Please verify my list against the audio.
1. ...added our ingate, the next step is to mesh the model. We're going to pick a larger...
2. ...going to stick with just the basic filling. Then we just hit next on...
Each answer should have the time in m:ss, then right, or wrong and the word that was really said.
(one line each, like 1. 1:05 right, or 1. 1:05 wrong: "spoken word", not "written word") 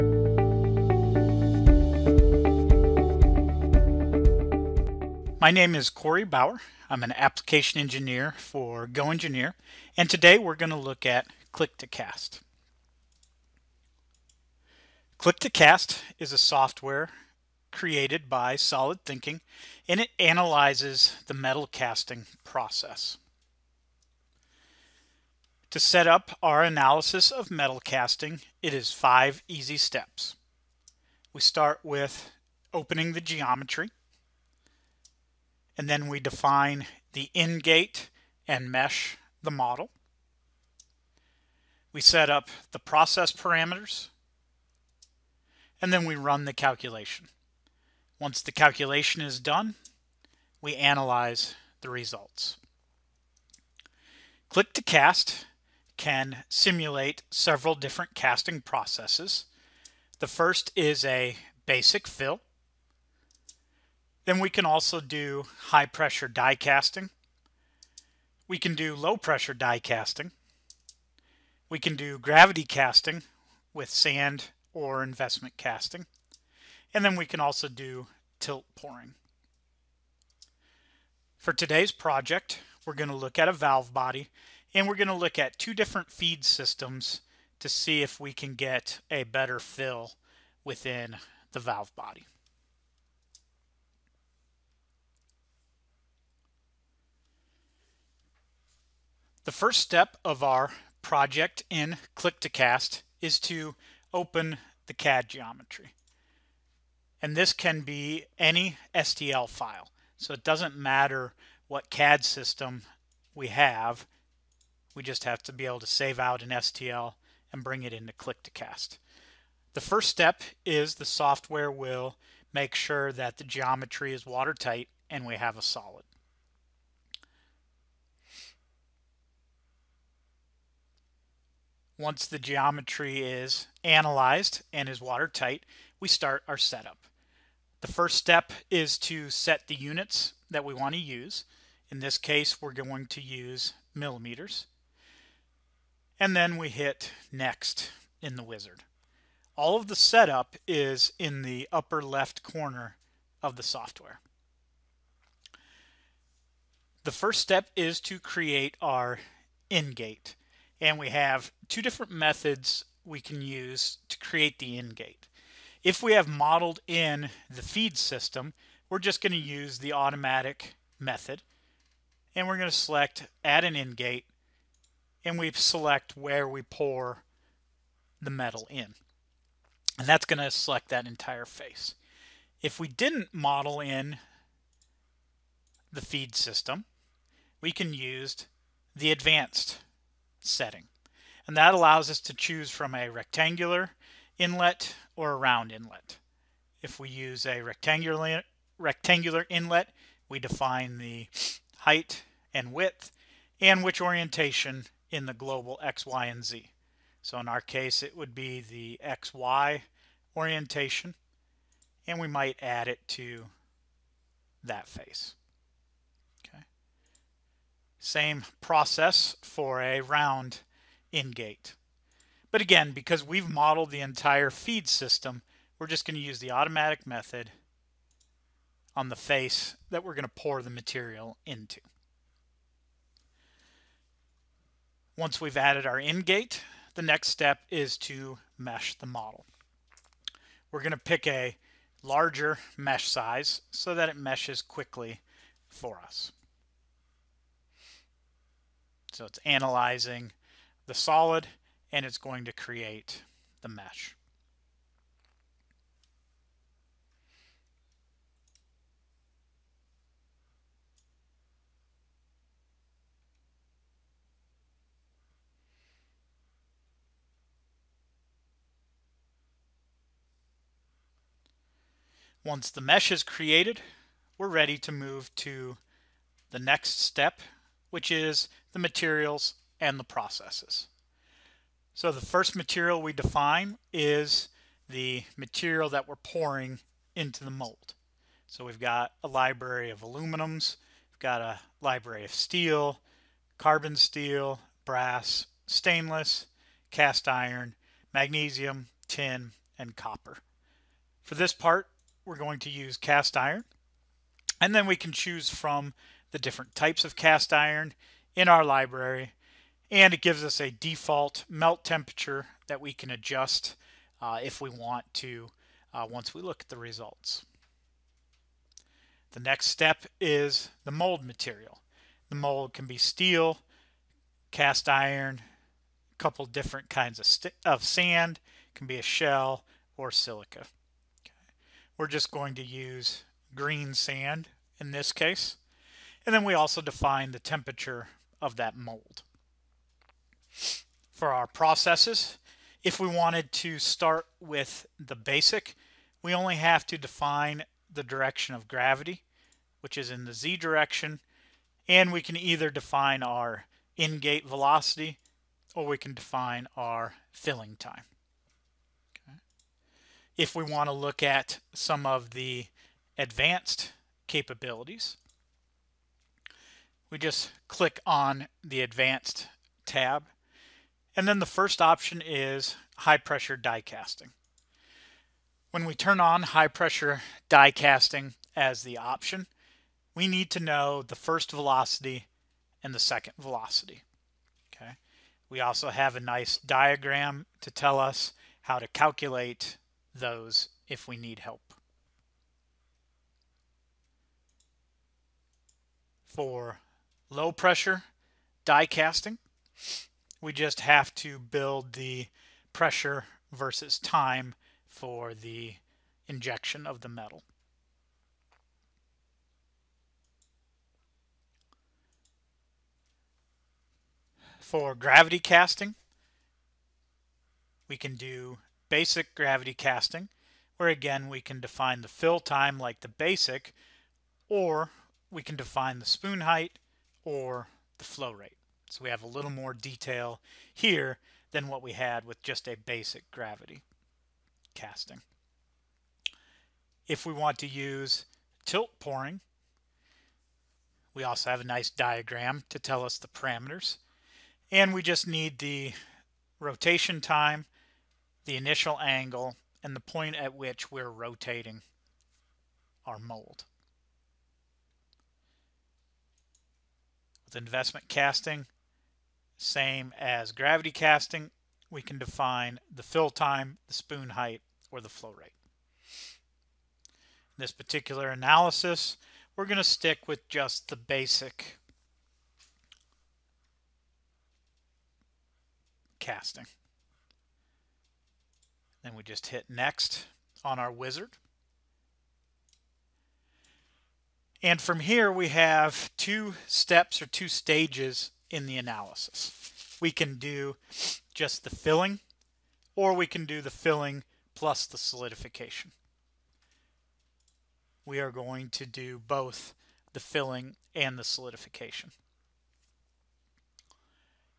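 1. 3:55 right
2. 7:49 wrong: "casting", not "filling".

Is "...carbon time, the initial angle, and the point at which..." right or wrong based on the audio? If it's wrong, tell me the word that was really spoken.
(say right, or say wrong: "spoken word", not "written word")
wrong: "rotation", not "carbon".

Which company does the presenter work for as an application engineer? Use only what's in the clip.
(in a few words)
GoEngineer.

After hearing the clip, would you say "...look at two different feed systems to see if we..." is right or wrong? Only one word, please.
right.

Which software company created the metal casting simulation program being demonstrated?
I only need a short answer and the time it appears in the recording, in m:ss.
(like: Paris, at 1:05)
solidThinking, at 0:18.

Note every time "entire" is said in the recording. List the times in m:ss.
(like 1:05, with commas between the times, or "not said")
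3:01, 3:43.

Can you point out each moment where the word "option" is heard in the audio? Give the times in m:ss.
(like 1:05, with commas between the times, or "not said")
6:11, 6:18.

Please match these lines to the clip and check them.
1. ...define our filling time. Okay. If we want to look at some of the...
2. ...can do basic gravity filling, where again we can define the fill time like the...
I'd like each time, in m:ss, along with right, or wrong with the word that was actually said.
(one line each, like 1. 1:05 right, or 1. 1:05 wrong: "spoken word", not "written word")
1. 5:56 right
2. 6:57 wrong: "casting", not "filling".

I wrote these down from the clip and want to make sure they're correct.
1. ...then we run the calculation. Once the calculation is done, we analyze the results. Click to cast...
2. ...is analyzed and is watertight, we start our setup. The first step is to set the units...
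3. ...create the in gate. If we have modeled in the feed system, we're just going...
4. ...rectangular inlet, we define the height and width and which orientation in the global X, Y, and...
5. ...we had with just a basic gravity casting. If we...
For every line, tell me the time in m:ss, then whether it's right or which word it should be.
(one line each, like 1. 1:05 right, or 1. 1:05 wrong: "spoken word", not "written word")
1. 0:45 right
2. 2:13 right
3. 2:44 right
4. 3:18 right
5. 7:11 right.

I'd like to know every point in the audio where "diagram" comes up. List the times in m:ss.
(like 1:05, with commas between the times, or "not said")
6:26, 7:21.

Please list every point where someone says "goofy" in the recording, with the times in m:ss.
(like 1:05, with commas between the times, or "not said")
not said.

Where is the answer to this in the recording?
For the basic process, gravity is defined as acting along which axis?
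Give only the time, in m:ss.
5:50.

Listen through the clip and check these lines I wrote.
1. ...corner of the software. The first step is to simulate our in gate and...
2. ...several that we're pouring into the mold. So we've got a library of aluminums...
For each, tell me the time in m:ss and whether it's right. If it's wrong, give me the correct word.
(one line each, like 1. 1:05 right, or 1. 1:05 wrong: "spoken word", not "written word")
1. 2:32 wrong: "create", not "simulate"
2. 4:45 wrong: "material", not "several".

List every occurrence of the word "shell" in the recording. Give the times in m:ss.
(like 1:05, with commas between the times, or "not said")
5:29.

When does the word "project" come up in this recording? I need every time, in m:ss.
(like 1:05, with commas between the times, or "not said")
1:21, 1:41.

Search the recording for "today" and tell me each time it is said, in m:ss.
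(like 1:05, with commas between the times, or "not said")
0:10, 1:21.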